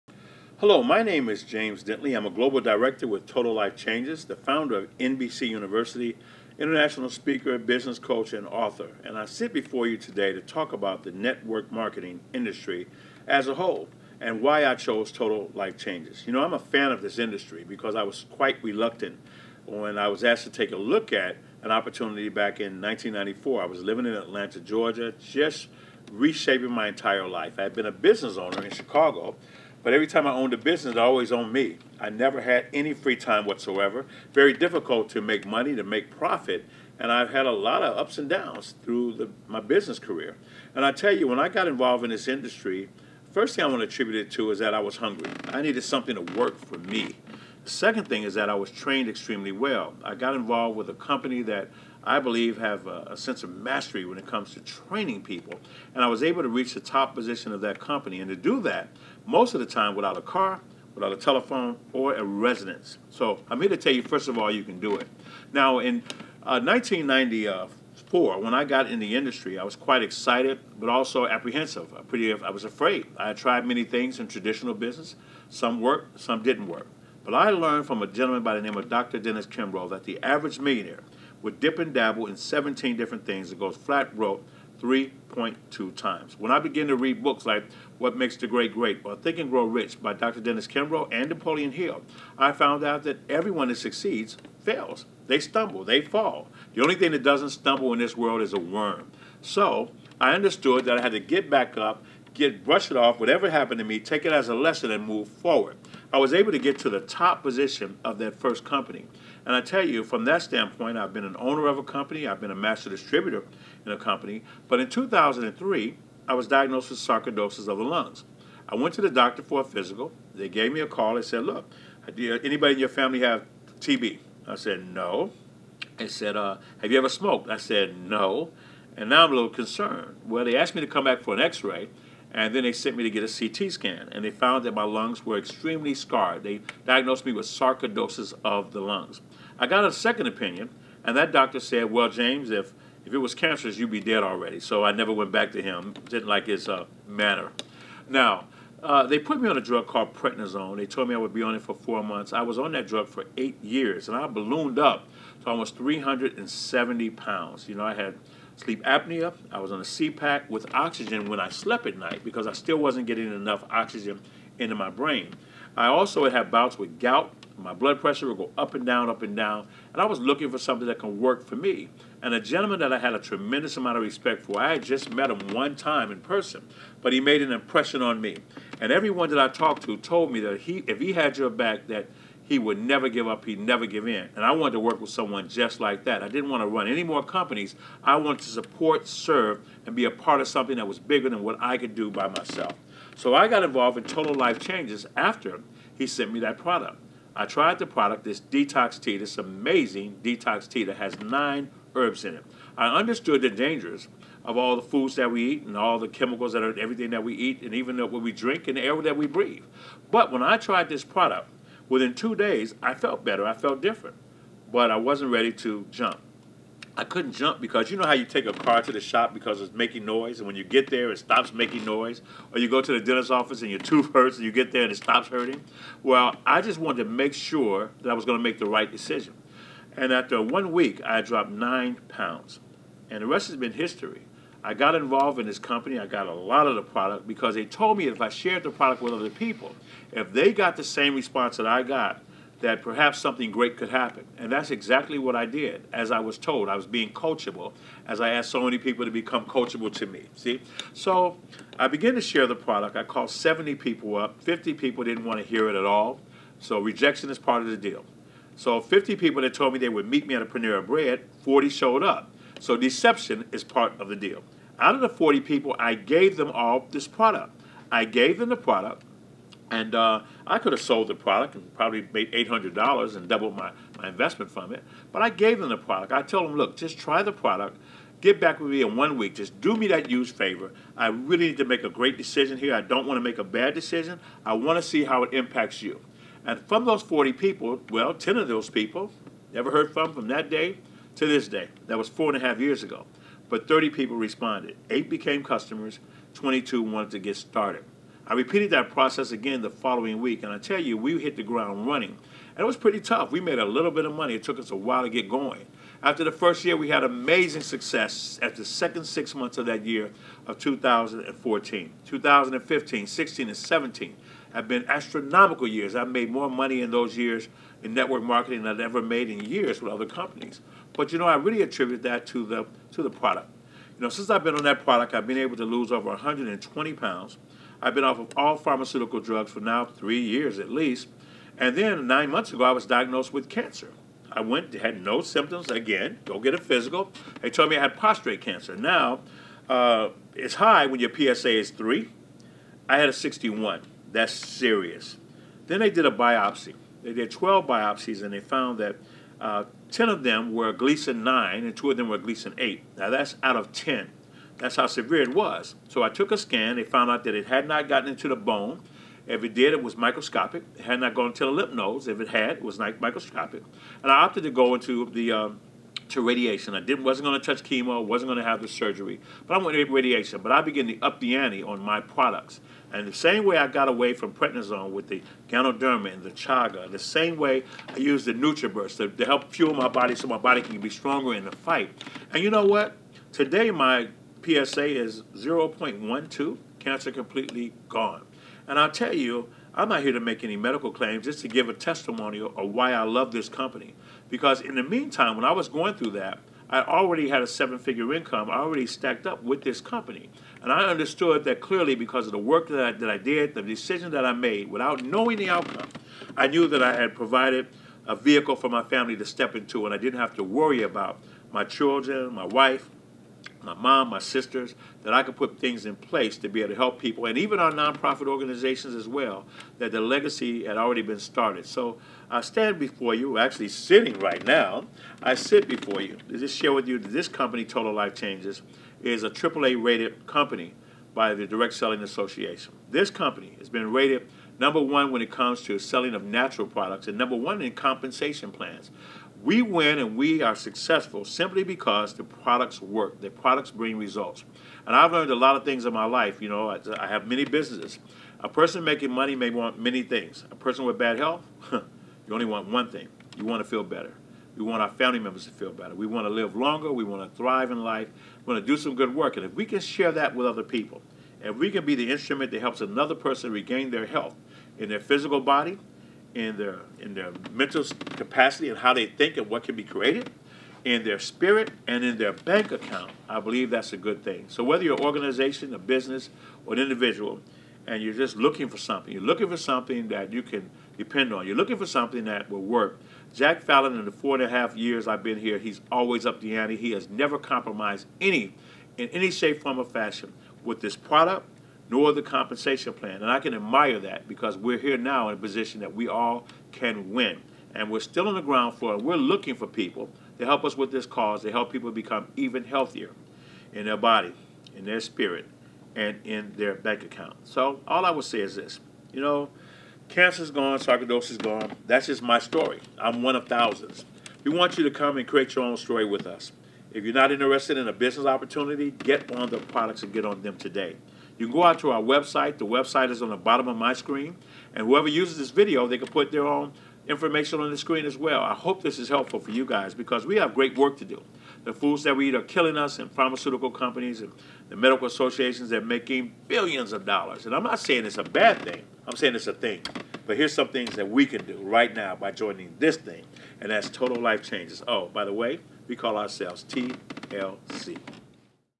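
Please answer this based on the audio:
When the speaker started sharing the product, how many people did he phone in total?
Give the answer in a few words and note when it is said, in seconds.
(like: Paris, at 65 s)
70, at 253 s.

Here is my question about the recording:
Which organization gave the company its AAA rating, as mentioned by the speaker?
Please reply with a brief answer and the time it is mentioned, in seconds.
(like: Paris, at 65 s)
Direct Selling Association, at 431 s.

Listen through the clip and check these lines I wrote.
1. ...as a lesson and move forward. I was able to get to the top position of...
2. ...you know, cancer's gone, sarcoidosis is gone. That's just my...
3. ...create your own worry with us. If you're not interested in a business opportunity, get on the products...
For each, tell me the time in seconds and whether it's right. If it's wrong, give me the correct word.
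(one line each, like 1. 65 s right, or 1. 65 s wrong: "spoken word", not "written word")
1. 104 s right
2. 509 s right
3. 515 s wrong: "story", not "worry".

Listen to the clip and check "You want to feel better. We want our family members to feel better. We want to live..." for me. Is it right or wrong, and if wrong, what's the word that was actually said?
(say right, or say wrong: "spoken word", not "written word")
right.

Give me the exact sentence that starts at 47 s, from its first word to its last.
Second thing is that I was trained extremely well.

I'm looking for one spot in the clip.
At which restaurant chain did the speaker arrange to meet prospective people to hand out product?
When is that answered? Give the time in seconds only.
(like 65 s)
260 s.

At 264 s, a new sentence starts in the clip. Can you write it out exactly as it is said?
Out of the 40 people, I gave them all this product.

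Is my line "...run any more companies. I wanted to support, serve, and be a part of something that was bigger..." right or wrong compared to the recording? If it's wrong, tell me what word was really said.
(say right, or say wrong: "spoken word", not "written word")
right.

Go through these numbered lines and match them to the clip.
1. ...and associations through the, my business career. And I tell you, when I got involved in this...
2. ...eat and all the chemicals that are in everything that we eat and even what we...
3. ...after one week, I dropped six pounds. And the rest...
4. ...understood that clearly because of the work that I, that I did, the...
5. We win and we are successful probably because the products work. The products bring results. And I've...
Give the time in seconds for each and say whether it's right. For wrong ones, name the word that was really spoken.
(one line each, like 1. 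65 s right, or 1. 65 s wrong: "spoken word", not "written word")
1. 38 s wrong: "downs", not "associations"
2. 205 s right
3. 230 s wrong: "nine", not "six"
4. 400 s right
5. 439 s wrong: "simply", not "probably".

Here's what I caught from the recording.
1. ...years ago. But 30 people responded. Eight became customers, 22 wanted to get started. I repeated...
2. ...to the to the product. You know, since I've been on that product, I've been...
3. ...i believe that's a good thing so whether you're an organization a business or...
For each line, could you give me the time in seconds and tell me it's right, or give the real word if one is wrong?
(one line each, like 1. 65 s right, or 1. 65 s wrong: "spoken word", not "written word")
1. 292 s right
2. 322 s right
3. 473 s right.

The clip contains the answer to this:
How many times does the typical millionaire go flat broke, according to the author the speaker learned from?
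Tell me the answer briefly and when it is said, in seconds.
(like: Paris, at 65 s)
3.2, at 84 s.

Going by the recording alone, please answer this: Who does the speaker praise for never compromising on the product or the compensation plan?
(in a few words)
Jack Fallon.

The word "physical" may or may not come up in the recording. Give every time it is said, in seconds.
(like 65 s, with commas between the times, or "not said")
119 s, 336 s, 464 s.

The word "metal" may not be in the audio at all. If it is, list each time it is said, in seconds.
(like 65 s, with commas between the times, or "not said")
not said.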